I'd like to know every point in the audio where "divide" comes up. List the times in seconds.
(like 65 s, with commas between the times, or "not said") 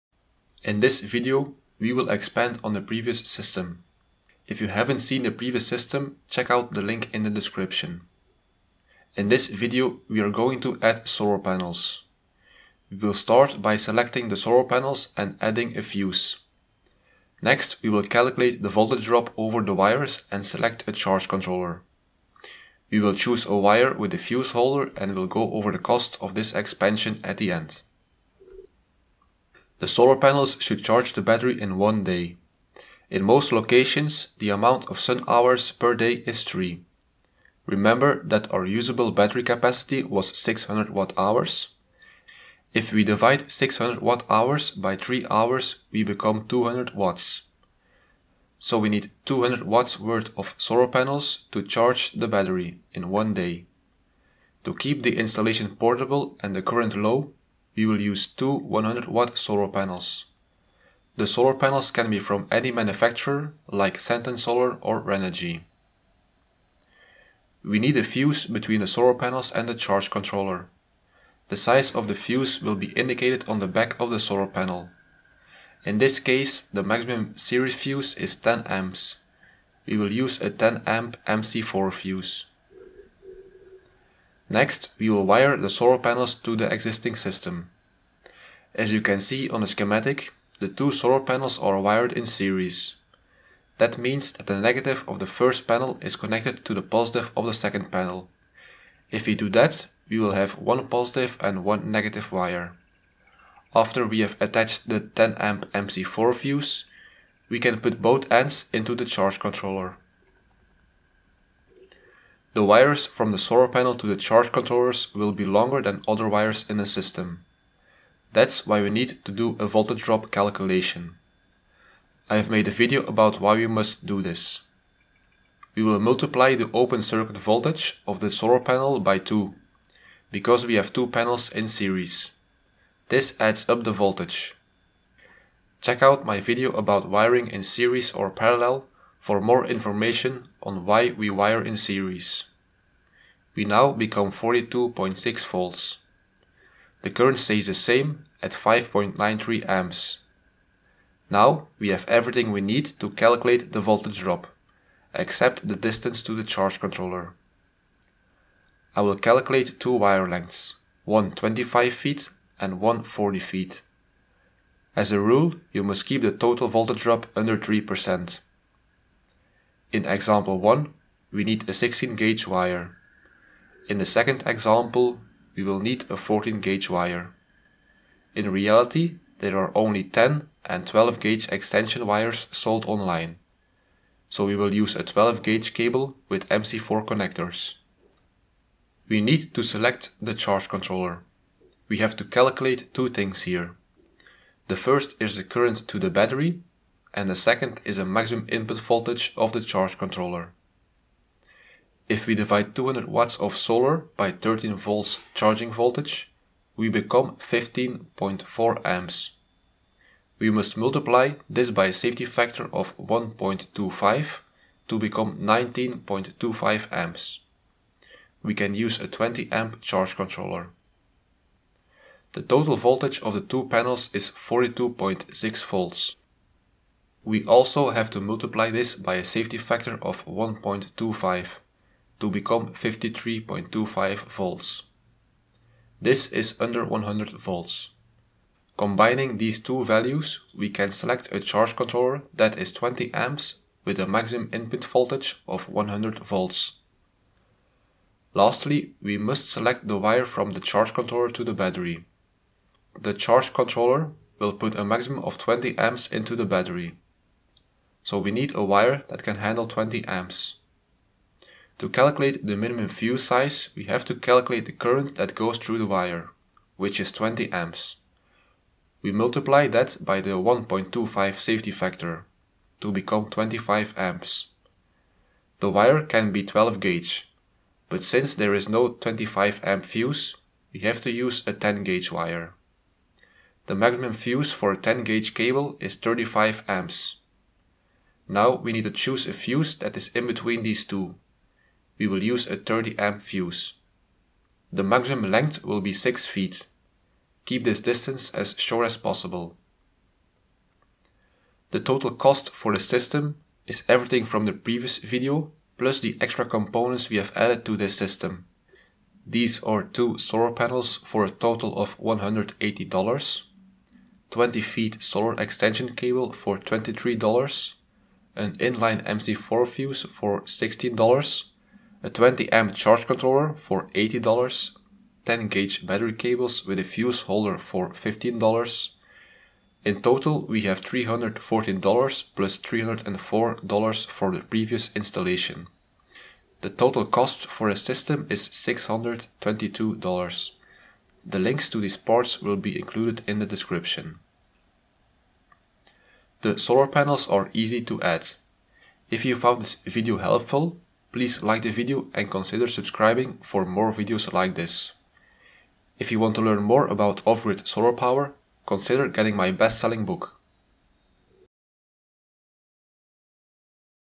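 43 s, 202 s.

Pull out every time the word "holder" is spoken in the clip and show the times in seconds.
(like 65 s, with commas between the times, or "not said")
24 s, 327 s.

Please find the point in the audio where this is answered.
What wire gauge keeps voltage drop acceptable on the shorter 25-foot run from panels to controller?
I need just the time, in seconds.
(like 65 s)
171 s.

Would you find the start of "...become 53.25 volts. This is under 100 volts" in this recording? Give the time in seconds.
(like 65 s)
232 s.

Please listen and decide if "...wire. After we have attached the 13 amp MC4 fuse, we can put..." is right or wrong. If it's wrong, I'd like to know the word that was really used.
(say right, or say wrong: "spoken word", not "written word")
wrong: "10", not "13".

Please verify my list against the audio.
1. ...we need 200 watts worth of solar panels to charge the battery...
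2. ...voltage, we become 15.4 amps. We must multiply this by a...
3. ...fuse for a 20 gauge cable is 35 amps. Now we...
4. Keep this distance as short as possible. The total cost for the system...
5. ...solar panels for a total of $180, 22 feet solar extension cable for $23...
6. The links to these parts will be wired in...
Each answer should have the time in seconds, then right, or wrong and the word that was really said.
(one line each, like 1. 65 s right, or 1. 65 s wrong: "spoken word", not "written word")
1. 48 s right
2. 205 s right
3. 284 s wrong: "10", not "20"
4. 297 s right
5. 310 s wrong: "20", not "22"
6. 341 s wrong: "included", not "wired".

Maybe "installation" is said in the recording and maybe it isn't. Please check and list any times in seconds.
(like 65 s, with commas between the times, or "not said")
55 s, 334 s.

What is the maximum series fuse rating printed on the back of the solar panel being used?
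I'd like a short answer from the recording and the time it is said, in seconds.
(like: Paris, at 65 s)
10 amps, at 78 s.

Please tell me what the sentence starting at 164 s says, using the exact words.
As a rule, you must keep the total voltage drop under 3%.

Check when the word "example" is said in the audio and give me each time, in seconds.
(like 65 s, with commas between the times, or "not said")
170 s, 174 s.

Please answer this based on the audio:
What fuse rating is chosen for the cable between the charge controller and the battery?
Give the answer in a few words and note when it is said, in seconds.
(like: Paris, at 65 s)
30 amp, at 292 s.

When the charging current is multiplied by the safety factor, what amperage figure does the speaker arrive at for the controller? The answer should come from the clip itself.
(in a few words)
19.25 amps.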